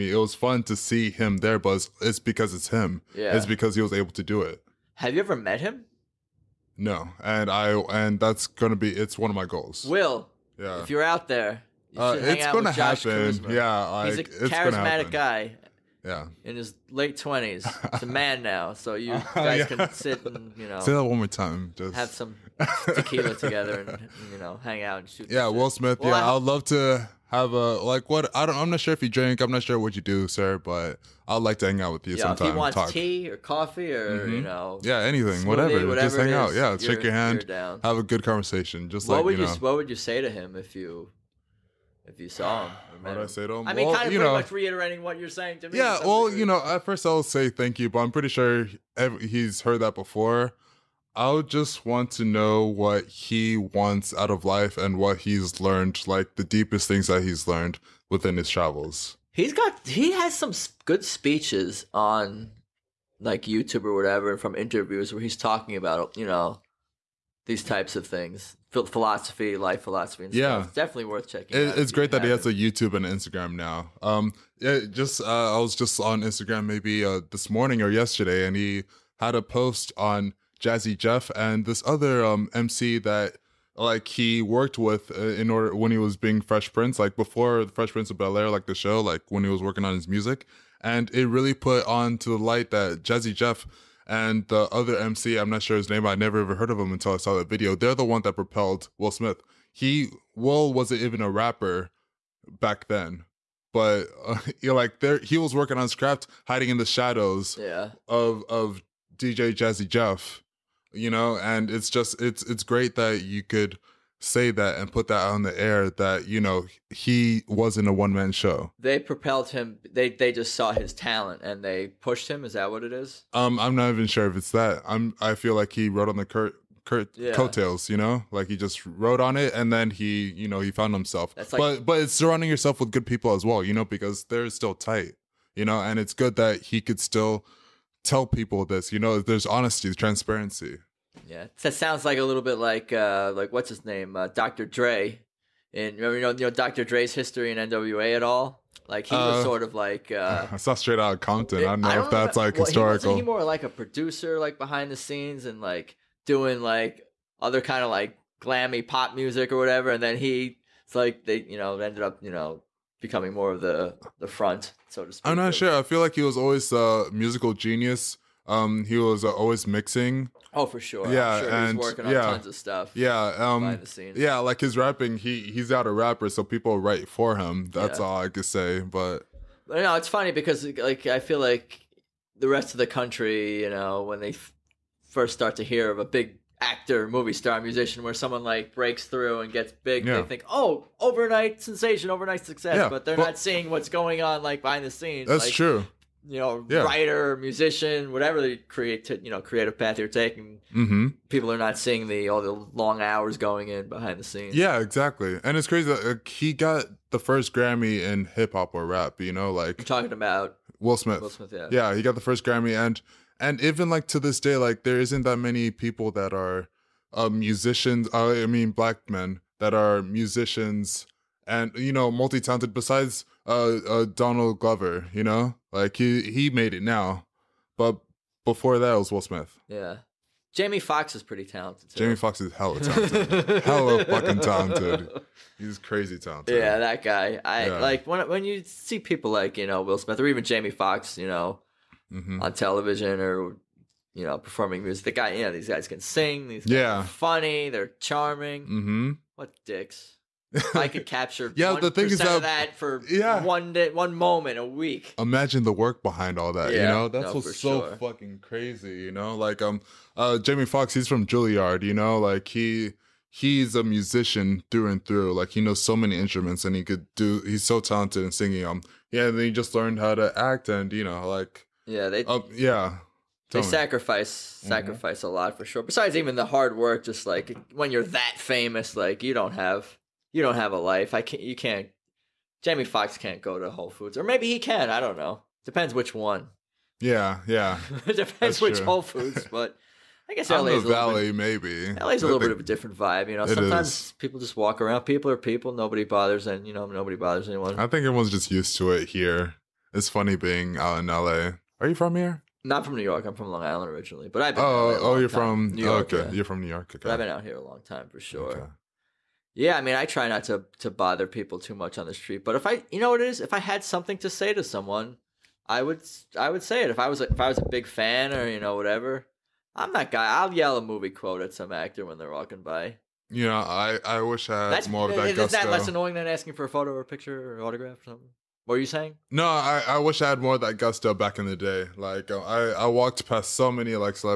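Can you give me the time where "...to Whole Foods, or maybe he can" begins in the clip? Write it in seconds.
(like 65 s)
283 s.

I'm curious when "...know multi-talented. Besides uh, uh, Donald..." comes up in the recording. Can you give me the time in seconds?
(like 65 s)
221 s.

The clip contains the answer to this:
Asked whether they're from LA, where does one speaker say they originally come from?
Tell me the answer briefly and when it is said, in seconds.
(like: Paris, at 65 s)
Long Island, at 303 s.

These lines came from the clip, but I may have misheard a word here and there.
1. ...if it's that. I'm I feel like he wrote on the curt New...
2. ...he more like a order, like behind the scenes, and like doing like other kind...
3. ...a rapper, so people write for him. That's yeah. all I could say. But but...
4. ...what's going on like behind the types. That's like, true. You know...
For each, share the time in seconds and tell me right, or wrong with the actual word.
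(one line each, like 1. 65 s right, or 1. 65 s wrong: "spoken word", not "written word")
1. 124 s wrong: "Kurt", not "New"
2. 153 s wrong: "producer", not "order"
3. 175 s right
4. 193 s wrong: "scenes", not "types".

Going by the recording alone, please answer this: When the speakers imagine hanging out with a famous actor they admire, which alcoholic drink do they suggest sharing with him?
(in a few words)
tequila.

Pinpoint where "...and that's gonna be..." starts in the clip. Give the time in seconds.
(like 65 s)
7 s.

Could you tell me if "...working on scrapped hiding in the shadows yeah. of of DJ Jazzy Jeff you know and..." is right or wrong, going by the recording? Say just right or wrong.
right.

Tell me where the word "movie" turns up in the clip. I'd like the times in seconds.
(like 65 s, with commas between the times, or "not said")
187 s, 320 s.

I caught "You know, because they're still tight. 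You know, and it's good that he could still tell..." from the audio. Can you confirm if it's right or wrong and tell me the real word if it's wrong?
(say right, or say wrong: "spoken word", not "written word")
right.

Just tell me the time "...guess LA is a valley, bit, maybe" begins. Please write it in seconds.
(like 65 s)
290 s.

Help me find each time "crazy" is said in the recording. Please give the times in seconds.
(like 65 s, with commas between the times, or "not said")
205 s, 235 s, 258 s.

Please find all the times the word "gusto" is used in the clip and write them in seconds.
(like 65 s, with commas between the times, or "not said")
325 s, 330 s.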